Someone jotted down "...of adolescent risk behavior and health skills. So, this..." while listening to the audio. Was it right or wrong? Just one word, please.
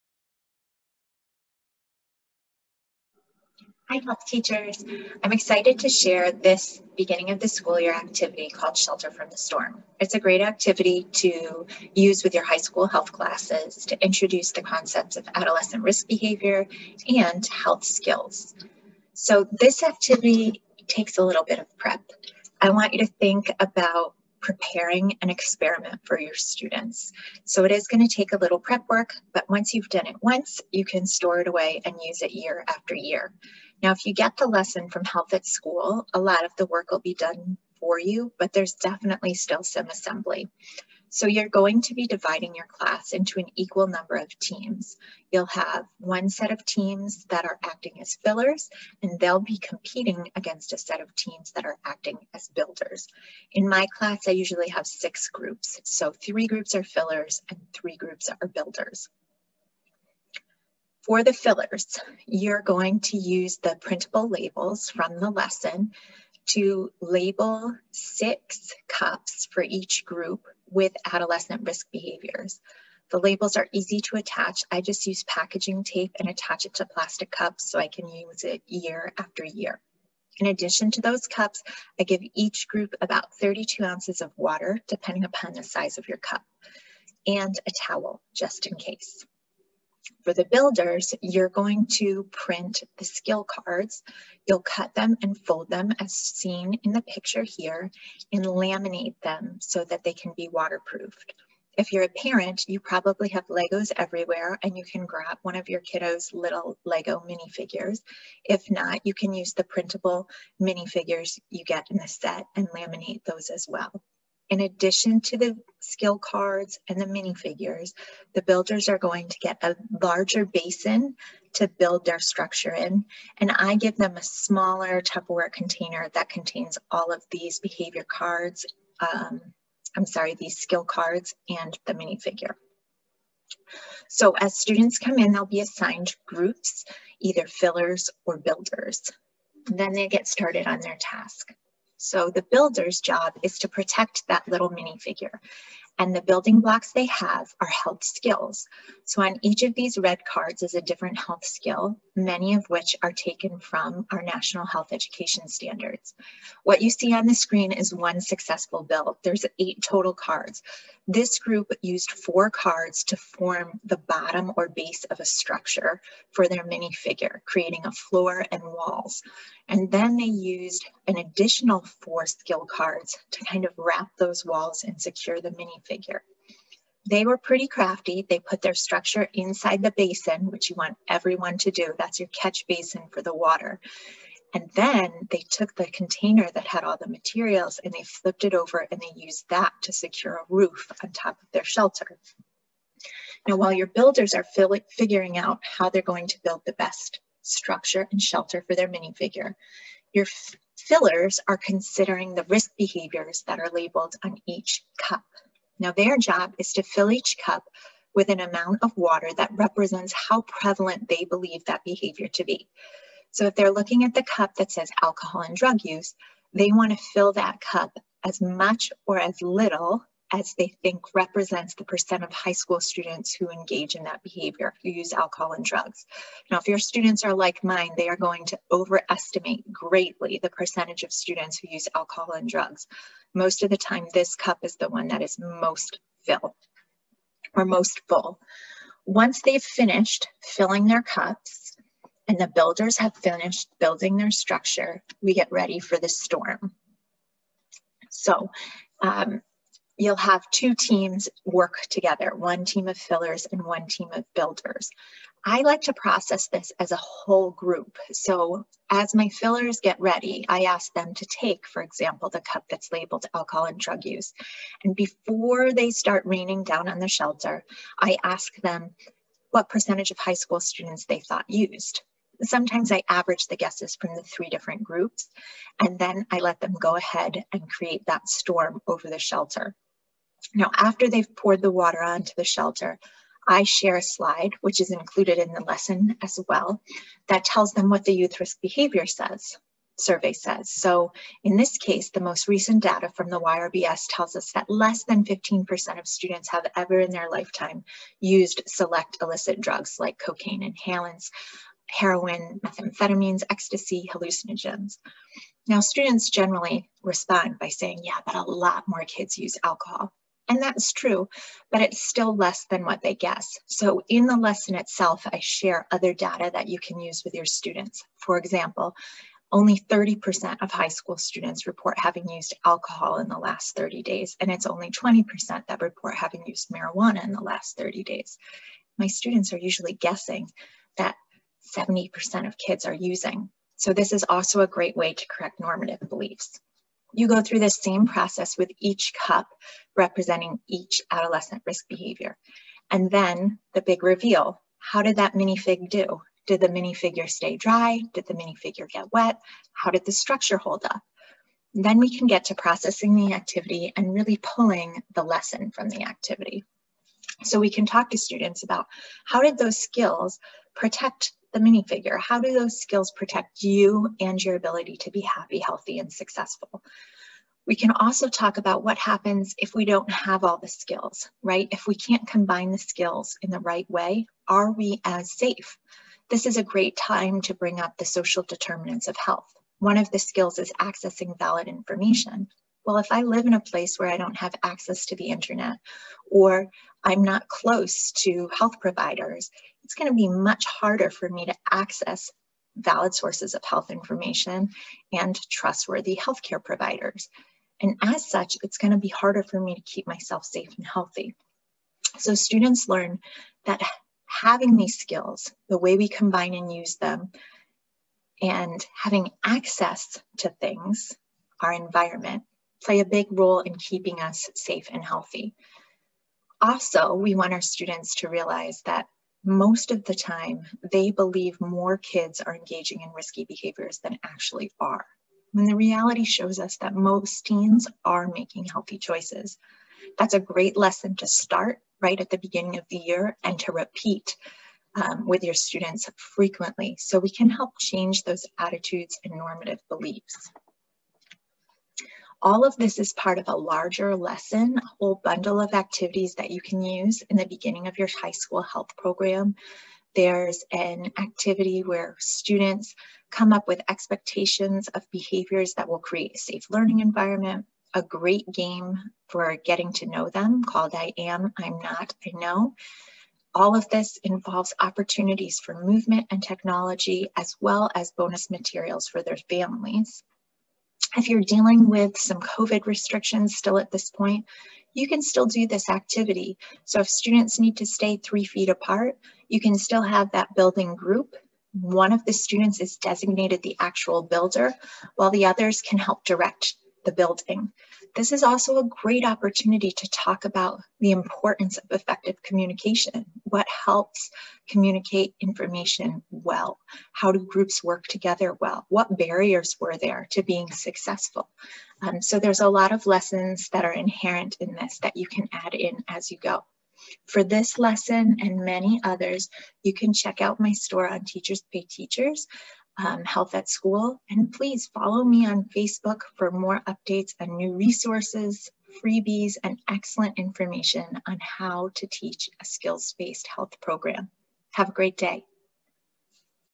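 right.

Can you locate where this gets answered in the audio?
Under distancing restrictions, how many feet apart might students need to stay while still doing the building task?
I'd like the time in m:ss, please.
7:58.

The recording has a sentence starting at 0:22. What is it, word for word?
I want you to think about preparing an experiment for your students.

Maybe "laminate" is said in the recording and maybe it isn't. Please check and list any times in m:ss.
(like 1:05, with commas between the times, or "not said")
1:38, 1:52.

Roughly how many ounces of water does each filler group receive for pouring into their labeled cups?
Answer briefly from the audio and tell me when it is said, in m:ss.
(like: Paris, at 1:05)
32 ounces, at 1:23.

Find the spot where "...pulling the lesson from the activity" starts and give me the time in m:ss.
5:54.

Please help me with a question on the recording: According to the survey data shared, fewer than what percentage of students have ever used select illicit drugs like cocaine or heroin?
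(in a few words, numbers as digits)
15%.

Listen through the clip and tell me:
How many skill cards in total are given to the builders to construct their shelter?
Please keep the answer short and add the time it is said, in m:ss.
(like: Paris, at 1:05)
8, at 2:39.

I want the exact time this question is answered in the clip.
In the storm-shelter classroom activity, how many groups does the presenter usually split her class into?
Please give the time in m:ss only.
0:54.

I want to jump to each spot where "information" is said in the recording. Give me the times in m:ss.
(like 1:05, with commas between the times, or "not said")
6:21, 6:33, 8:15, 8:40.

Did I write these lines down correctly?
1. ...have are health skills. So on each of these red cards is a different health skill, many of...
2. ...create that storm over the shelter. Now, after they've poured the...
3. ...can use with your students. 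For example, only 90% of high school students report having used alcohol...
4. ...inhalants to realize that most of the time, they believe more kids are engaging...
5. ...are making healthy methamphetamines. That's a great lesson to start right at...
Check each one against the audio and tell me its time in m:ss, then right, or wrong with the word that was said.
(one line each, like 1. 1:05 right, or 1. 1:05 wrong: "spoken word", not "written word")
1. 2:27 right
2. 4:37 right
3. 5:16 wrong: "30", not "90"
4. 6:57 wrong: "students", not "inhalants"
5. 7:08 wrong: "choices", not "methamphetamines".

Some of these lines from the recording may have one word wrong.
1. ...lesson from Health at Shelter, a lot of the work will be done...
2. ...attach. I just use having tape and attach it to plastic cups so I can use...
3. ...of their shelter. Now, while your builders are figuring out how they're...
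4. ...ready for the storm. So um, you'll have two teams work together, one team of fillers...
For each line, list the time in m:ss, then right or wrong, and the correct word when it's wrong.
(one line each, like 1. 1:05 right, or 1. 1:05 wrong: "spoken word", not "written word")
1. 0:34 wrong: "School", not "Shelter"
2. 1:14 wrong: "packaging", not "having"
3. 3:11 right
4. 4:05 right.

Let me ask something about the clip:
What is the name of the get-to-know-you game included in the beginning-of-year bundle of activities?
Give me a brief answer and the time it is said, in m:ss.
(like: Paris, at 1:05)
I Am, I'm Not, I Know, at 7:40.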